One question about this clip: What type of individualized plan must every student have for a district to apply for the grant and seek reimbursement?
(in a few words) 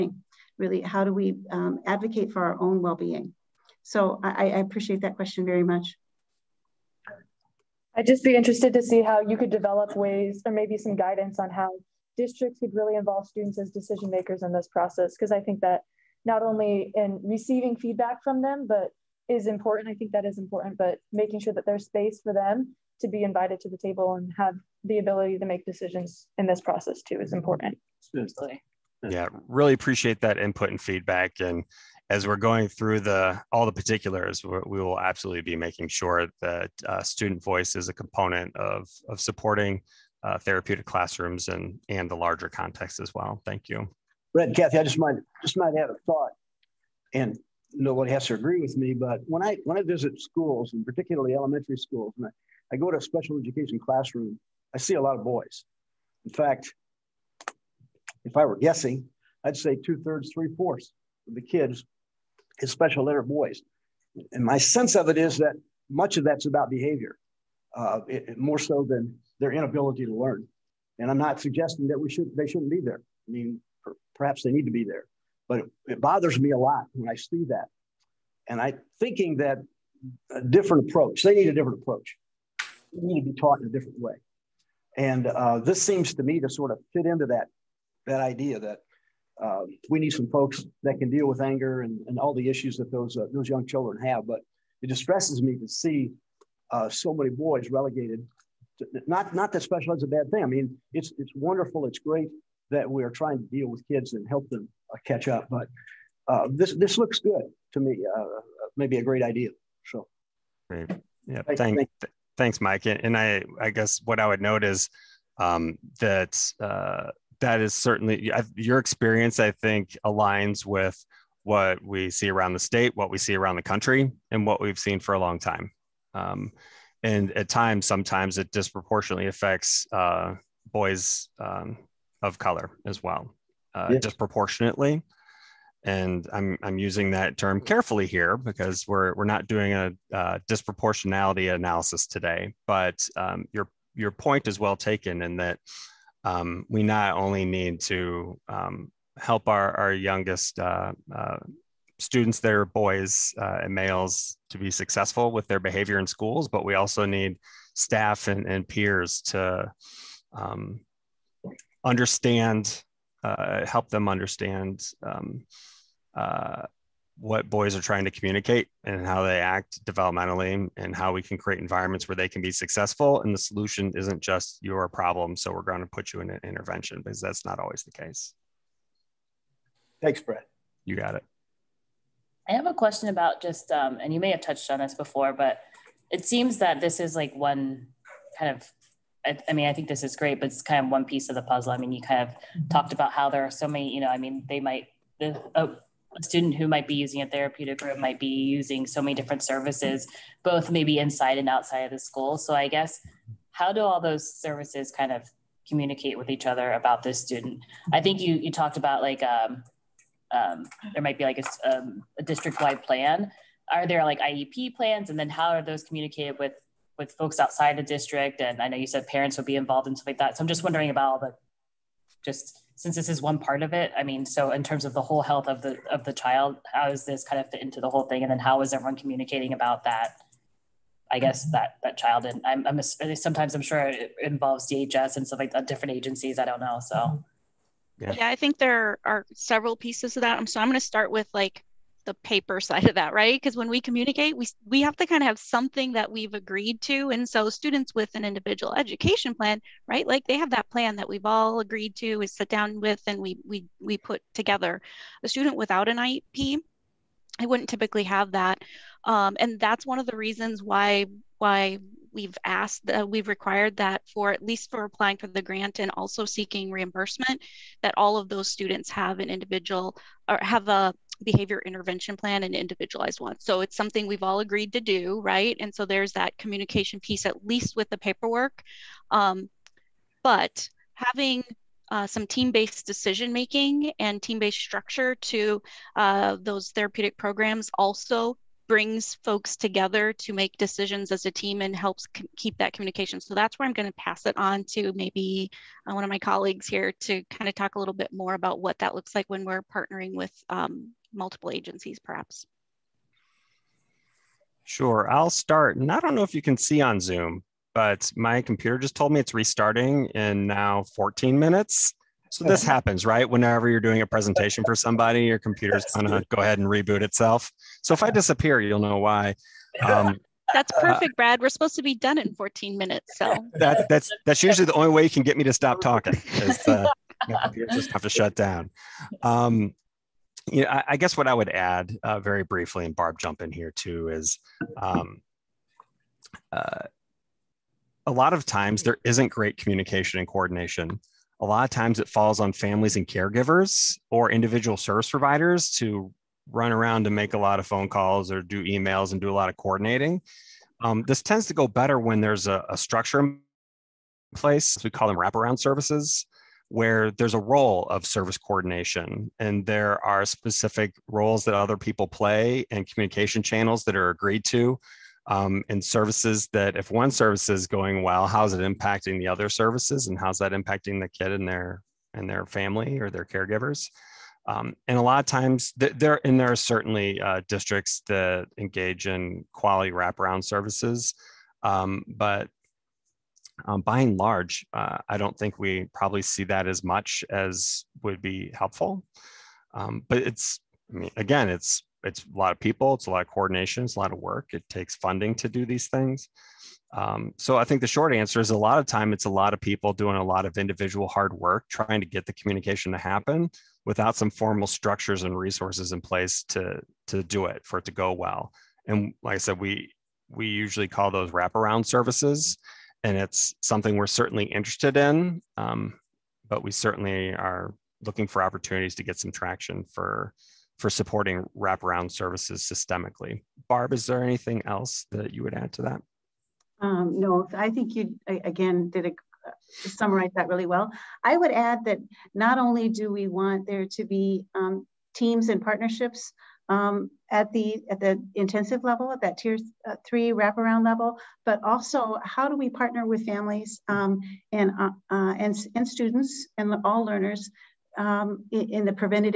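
behavior intervention plan.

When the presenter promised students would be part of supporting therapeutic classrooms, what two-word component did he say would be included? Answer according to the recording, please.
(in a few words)
student voice.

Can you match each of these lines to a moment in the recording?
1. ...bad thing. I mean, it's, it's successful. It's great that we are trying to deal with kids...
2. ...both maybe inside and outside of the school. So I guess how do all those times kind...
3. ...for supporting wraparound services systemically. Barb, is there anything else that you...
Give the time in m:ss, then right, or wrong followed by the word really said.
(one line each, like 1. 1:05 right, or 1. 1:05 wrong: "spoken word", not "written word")
1. 1:40 wrong: "wonderful", not "successful"
2. 3:20 wrong: "services", not "times"
3. 7:00 right.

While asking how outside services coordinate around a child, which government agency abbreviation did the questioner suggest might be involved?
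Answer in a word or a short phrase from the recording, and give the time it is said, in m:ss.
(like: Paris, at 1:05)
DHS, at 3:54.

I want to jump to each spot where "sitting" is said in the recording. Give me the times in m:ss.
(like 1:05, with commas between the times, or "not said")
not said.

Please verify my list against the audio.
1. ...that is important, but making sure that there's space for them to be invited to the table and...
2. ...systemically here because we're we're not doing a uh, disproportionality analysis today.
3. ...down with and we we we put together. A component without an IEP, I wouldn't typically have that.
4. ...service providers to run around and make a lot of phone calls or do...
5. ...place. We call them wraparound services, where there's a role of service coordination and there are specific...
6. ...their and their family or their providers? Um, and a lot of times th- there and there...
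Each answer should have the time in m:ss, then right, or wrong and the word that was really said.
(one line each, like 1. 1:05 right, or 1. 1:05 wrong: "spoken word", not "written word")
1. 0:20 right
2. 2:17 wrong: "carefully", not "systemically"
3. 4:12 wrong: "student", not "component"
4. 5:44 right
5. 5:54 right
6. 6:11 wrong: "caregivers", not "providers".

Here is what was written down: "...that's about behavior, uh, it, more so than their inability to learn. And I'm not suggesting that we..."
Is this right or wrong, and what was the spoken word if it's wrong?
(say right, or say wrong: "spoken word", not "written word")
right.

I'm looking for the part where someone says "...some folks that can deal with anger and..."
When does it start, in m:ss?
1:30.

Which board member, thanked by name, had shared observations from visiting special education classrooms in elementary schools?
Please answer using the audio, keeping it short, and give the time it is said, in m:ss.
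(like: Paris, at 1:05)
Mike, at 1:52.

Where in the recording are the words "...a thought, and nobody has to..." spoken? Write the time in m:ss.
0:45.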